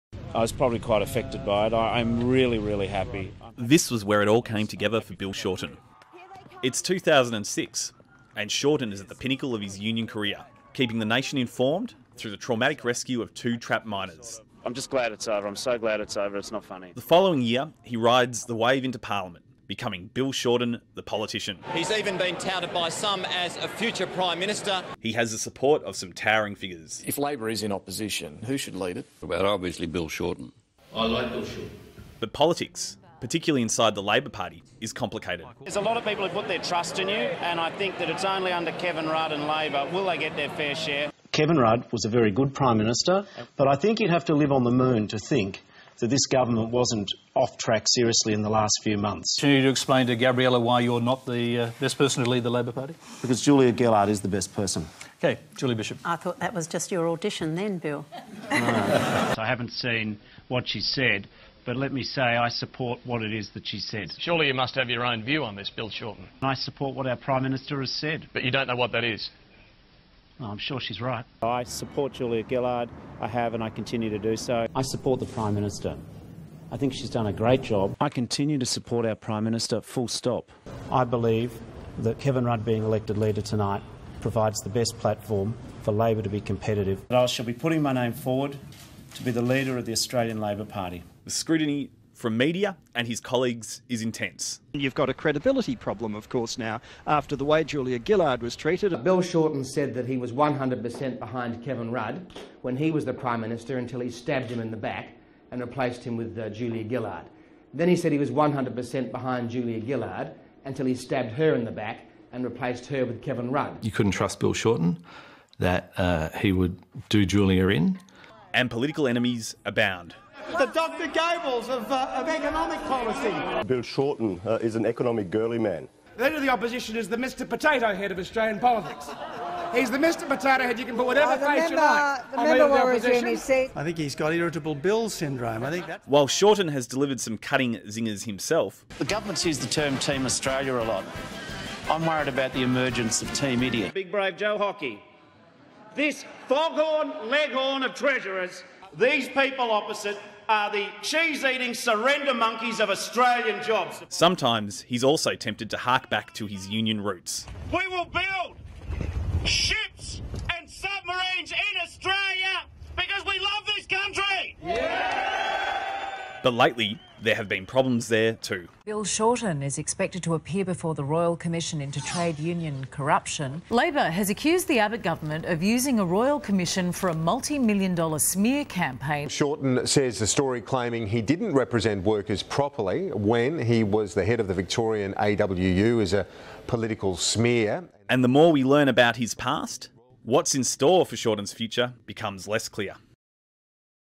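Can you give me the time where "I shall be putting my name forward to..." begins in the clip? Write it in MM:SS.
01:27.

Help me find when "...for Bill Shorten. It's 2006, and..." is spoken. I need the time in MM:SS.
00:05.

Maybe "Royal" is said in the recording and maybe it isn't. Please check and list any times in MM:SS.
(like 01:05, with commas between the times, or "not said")
02:51, 02:56.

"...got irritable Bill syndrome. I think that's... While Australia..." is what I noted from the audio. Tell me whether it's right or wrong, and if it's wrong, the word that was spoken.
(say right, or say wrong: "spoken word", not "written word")
wrong: "Shorten", not "Australia".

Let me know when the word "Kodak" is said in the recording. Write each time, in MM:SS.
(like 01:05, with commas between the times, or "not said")
not said.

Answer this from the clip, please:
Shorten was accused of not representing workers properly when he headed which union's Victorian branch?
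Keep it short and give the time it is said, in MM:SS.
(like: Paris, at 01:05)
AWU, at 03:05.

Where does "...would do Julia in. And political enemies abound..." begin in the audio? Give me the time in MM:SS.
01:56.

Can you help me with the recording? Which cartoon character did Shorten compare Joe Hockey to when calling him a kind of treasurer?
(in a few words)
Foghorn Leghorn.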